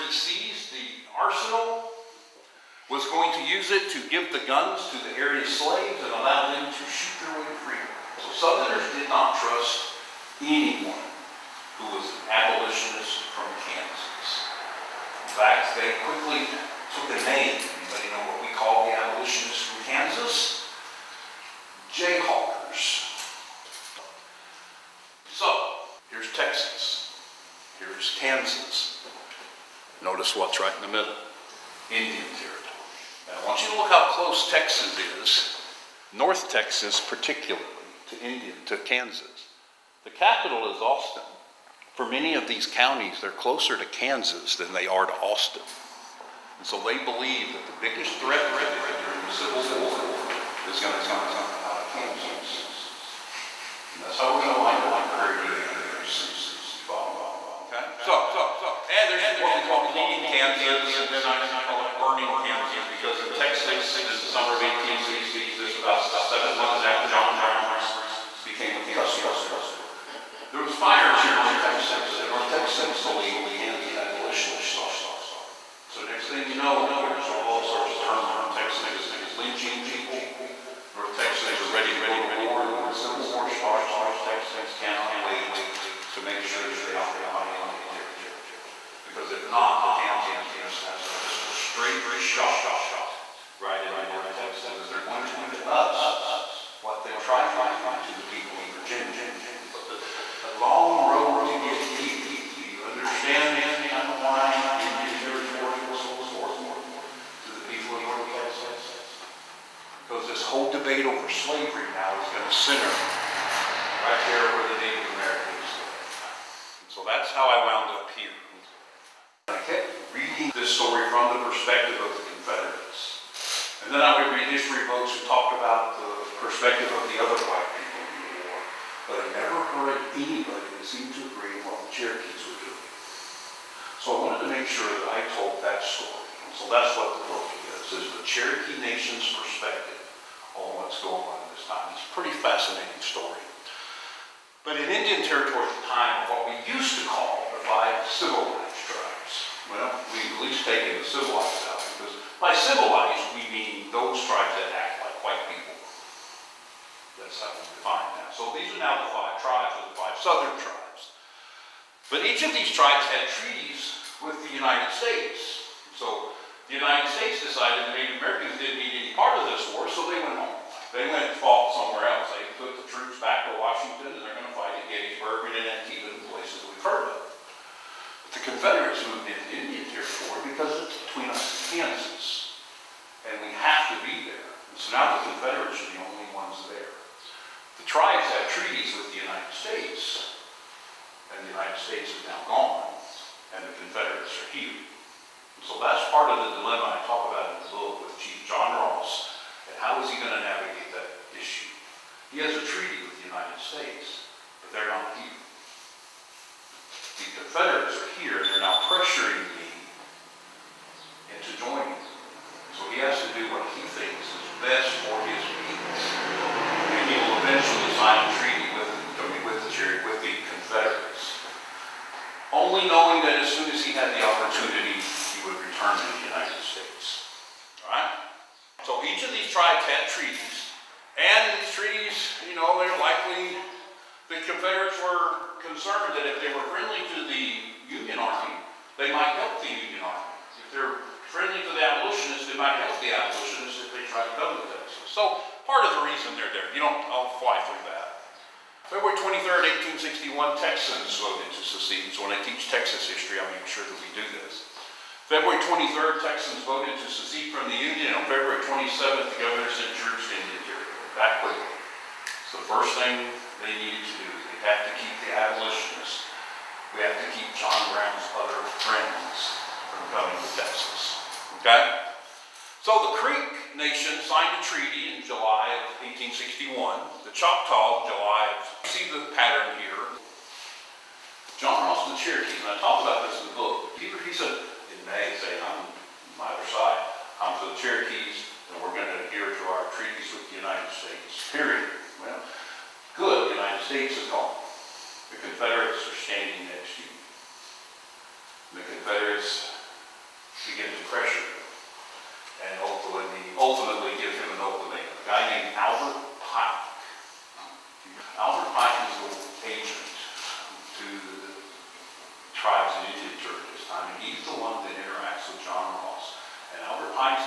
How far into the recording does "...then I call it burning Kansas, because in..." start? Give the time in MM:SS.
01:01.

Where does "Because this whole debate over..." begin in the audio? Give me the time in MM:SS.
01:50.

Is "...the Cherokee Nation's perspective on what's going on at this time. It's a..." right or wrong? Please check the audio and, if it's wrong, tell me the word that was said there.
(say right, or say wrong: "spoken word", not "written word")
right.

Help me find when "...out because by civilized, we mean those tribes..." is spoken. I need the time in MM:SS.
02:31.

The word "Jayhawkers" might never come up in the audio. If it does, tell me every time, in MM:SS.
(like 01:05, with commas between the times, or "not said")
00:21.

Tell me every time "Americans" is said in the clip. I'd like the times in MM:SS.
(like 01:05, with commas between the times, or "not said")
01:55, 02:48.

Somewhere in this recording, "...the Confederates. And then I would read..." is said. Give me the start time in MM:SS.
02:02.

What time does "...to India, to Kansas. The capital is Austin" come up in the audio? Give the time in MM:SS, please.
00:38.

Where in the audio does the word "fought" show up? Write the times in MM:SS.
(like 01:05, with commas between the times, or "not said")
02:51.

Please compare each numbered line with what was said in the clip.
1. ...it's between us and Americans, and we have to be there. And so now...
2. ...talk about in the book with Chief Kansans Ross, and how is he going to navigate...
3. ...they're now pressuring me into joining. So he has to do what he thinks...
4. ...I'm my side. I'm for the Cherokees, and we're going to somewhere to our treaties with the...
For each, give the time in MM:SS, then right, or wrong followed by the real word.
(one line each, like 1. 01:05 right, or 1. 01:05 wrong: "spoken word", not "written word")
1. 03:00 wrong: "Kansas", not "Americans"
2. 03:17 wrong: "John", not "Kansans"
3. 03:28 right
4. 04:45 wrong: "adhere", not "somewhere".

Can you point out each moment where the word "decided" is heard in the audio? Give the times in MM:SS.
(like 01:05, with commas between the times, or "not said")
02:47.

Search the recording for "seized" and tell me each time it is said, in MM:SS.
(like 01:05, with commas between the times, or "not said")
00:00.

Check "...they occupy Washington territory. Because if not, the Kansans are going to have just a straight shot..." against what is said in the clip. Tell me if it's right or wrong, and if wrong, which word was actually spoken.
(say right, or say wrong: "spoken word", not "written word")
wrong: "Indian", not "Washington".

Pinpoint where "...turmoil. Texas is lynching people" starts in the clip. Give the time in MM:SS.
01:18.